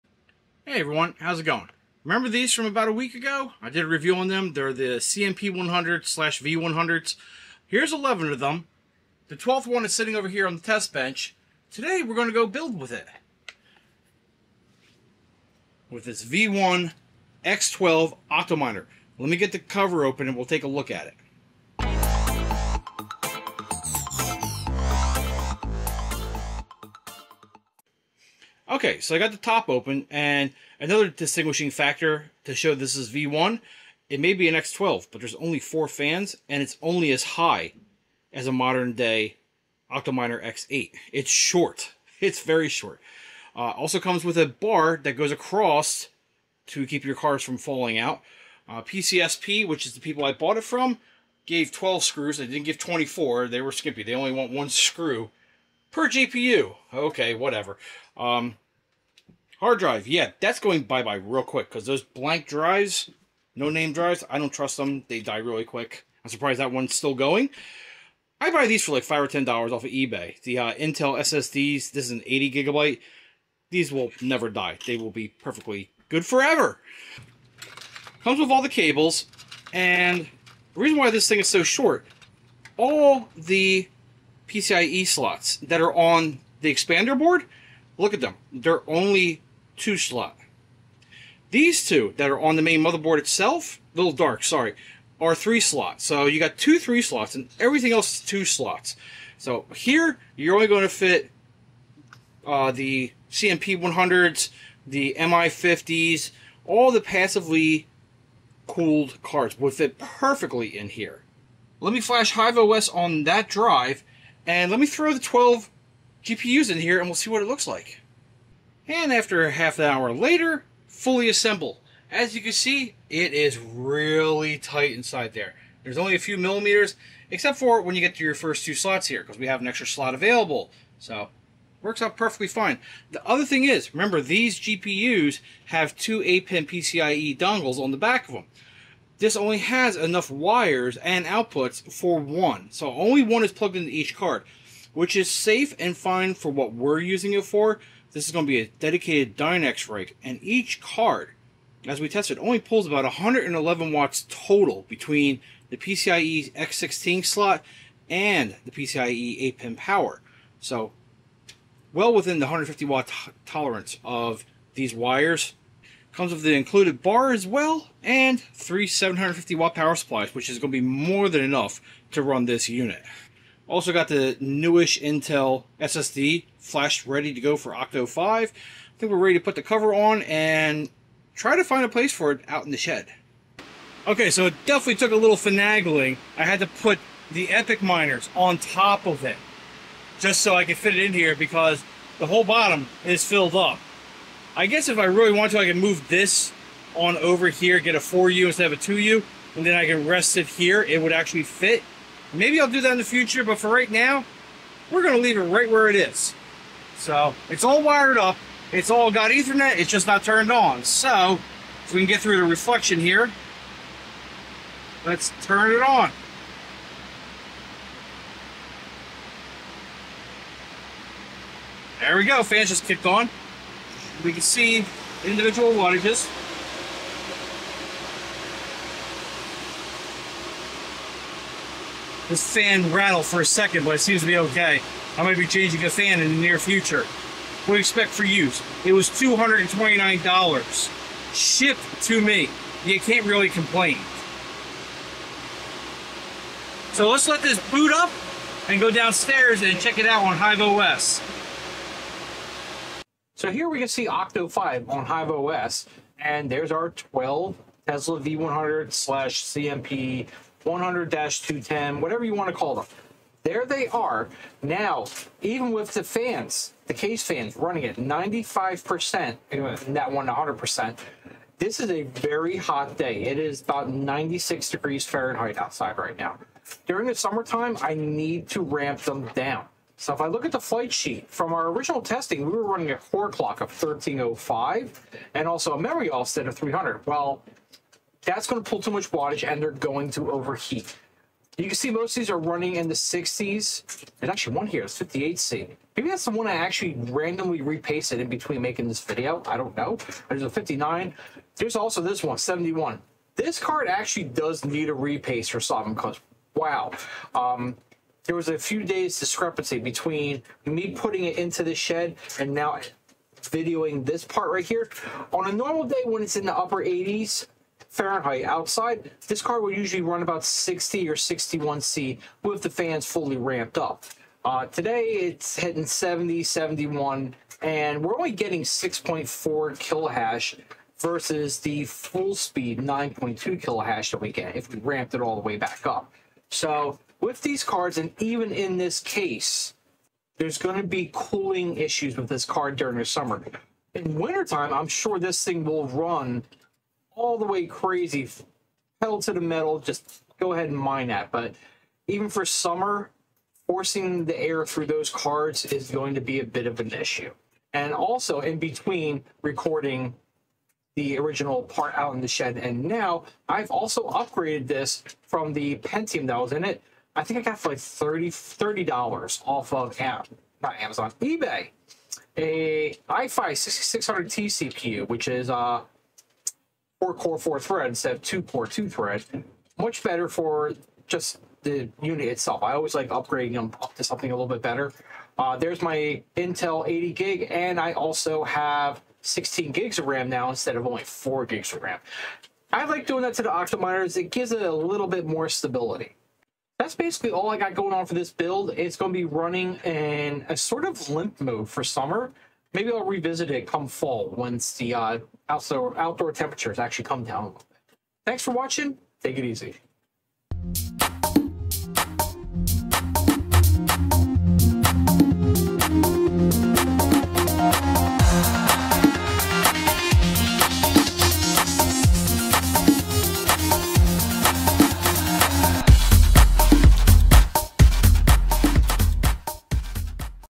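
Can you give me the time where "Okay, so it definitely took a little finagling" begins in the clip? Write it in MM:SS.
03:04.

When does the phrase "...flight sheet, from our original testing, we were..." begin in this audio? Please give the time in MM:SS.
04:40.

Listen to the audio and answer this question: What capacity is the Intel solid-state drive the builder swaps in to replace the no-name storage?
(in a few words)
80 gigabyte.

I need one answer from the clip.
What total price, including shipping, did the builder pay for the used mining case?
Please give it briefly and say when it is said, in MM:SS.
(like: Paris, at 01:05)
$229, at 03:59.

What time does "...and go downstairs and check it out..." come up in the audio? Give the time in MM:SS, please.
04:08.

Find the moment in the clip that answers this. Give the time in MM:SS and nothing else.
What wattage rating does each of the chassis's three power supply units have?
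02:48.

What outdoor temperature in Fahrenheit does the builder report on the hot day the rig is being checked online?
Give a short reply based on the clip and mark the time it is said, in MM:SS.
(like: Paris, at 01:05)
96 degrees, at 04:33.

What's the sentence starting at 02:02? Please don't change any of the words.
As you can see, it is really tight inside there.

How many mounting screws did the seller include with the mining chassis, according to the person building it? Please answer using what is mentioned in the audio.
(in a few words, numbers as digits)
12.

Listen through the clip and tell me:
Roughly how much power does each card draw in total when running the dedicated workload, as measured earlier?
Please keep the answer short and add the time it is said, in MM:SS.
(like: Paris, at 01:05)
111 watts, at 02:33.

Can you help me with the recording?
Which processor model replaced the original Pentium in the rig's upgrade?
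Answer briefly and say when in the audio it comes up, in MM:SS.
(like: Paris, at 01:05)
i5 6600T, at 06:13.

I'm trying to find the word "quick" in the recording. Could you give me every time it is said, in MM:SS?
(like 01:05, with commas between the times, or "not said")
01:01, 01:05.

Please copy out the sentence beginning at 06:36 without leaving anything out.
That's basically all I got going on for this build.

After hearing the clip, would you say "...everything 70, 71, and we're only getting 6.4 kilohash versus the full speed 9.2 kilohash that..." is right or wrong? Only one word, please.
wrong.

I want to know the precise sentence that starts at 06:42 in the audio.
Maybe I'll revisit it come fall once the uh, outdoor, outdoor temperatures actually come down a little bit.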